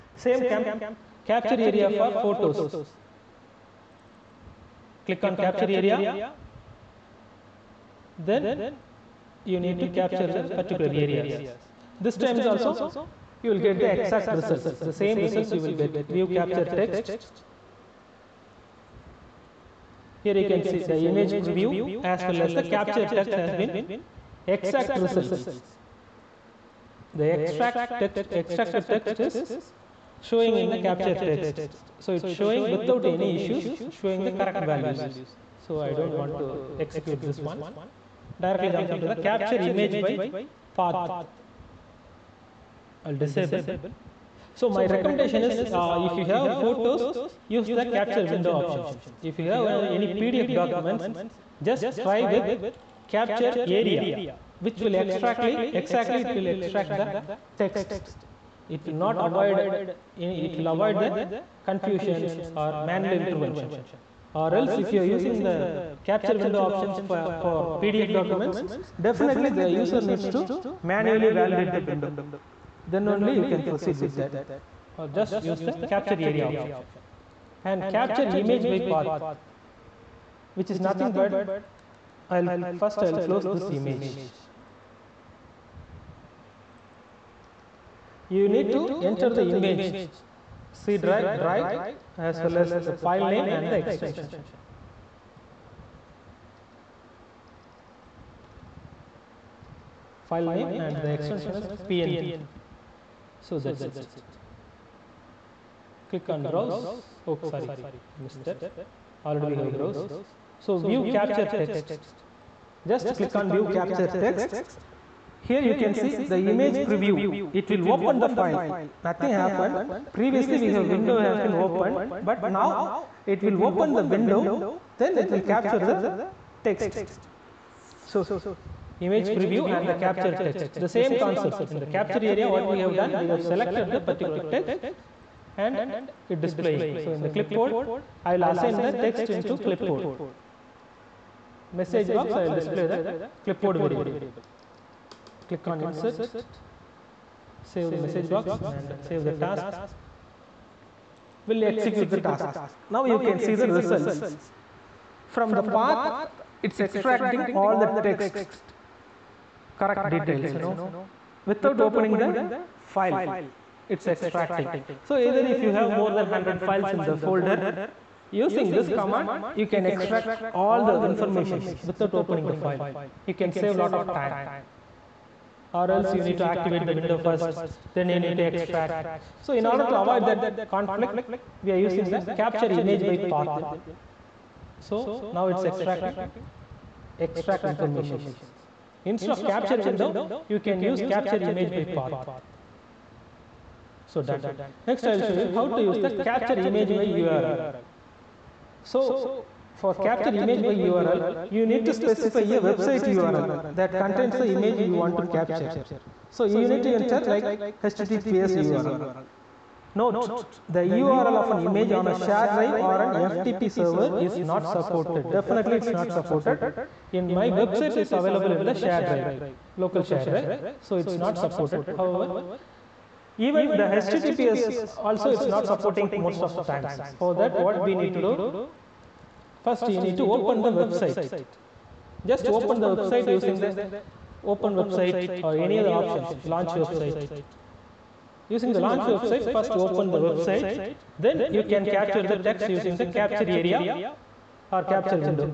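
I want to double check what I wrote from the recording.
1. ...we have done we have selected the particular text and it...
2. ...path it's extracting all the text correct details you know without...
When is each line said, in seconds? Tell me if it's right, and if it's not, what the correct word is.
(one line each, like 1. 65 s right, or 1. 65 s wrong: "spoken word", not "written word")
1. 132 s right
2. 155 s right.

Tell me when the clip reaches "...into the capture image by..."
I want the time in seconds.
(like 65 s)
38 s.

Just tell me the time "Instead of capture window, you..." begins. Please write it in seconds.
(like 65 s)
189 s.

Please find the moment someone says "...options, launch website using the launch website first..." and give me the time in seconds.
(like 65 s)
235 s.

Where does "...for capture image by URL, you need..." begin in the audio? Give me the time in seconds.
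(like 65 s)
199 s.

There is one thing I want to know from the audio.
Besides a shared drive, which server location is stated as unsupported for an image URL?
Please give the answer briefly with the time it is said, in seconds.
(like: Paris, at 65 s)
FTP server, at 213 s.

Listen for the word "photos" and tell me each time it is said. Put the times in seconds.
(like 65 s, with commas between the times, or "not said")
2 s, 46 s.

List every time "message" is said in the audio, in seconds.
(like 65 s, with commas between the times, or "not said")
141 s, 148 s.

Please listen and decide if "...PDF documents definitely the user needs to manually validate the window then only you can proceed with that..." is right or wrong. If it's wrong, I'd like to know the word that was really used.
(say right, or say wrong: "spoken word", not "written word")
right.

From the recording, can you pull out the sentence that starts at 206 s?
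So you need to enter like HTTPS URL.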